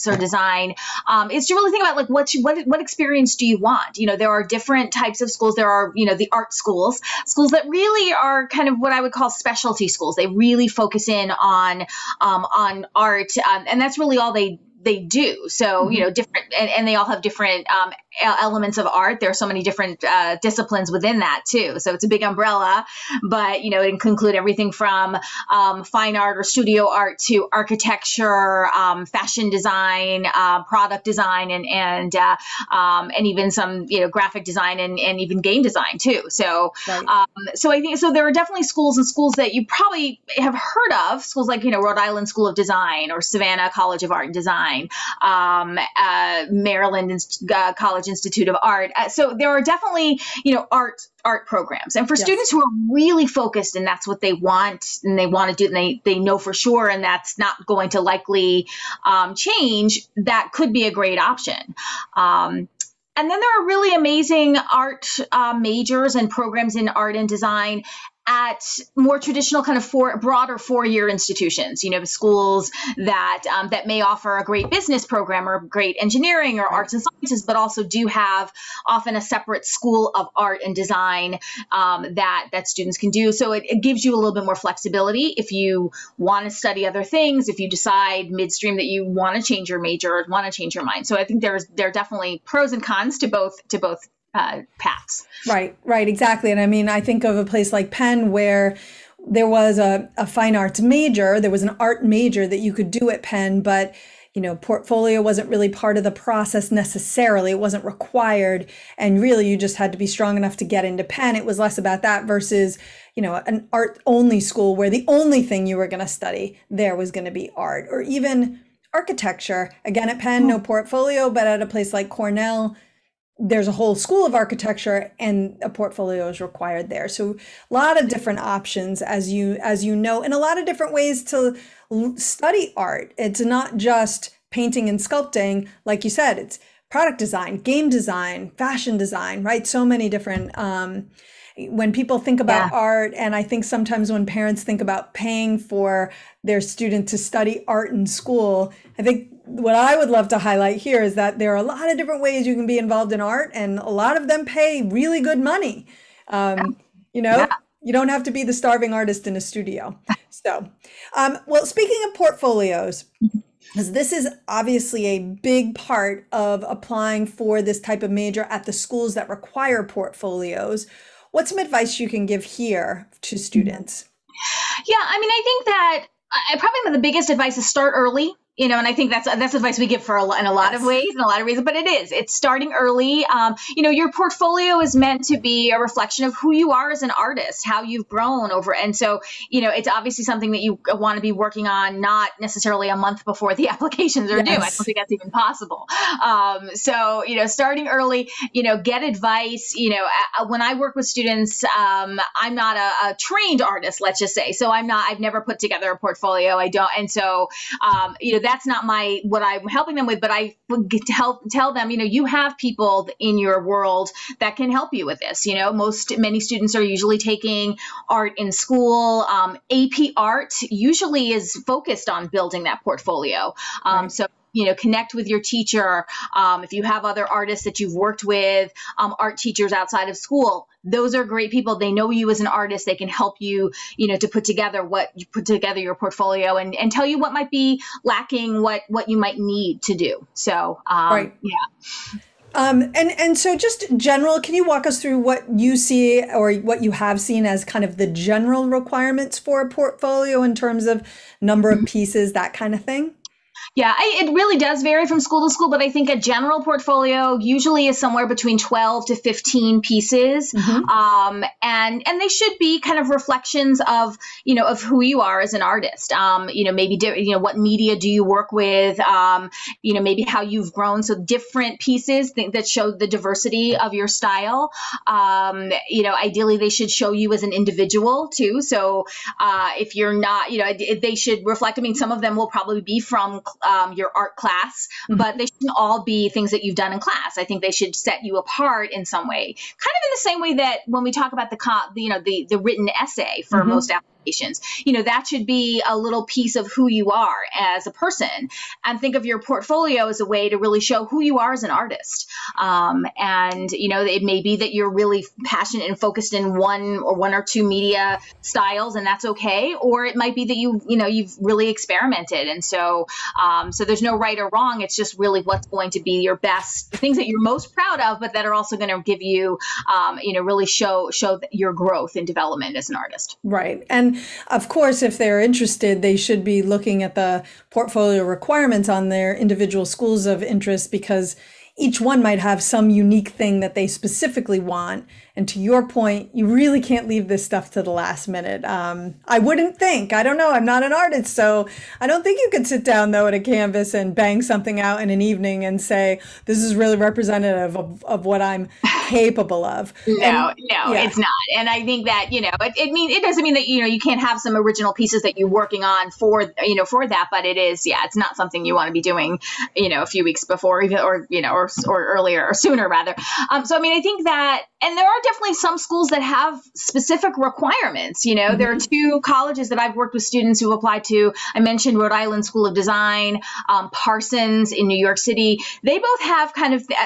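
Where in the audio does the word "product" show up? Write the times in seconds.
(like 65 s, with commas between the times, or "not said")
30 s, 136 s.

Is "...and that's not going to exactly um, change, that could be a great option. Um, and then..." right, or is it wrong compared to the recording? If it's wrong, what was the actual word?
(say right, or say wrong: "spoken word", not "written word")
wrong: "likely", not "exactly".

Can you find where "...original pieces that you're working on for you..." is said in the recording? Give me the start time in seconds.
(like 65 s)
354 s.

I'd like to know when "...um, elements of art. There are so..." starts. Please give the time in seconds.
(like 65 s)
17 s.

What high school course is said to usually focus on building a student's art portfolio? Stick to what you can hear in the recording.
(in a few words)
AP art.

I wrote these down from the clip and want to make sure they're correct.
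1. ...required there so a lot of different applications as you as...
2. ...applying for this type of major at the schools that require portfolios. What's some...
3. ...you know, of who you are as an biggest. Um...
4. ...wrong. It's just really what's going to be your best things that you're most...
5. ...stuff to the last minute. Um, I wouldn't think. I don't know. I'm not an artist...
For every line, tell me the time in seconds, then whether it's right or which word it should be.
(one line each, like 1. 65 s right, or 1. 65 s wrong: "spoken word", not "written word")
1. 126 s wrong: "options", not "applications"
2. 166 s right
3. 264 s wrong: "artist", not "biggest"
4. 314 s right
5. 337 s right.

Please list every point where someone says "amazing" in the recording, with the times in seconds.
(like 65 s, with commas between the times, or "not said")
63 s.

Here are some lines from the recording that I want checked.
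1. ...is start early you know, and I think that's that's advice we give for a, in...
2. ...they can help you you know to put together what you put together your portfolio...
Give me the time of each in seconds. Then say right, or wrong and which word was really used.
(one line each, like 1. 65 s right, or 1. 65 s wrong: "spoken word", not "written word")
1. 177 s right
2. 232 s right.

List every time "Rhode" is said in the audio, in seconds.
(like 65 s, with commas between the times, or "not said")
41 s, 371 s.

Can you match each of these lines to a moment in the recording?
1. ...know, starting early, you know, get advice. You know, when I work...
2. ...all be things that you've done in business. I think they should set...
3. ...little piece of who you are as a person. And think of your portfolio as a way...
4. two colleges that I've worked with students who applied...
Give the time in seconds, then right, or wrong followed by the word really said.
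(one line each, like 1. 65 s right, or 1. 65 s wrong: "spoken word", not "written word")
1. 197 s right
2. 285 s wrong: "class", not "business"
3. 295 s right
4. 369 s right.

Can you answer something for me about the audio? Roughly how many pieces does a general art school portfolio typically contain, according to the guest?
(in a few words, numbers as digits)
12 to 15.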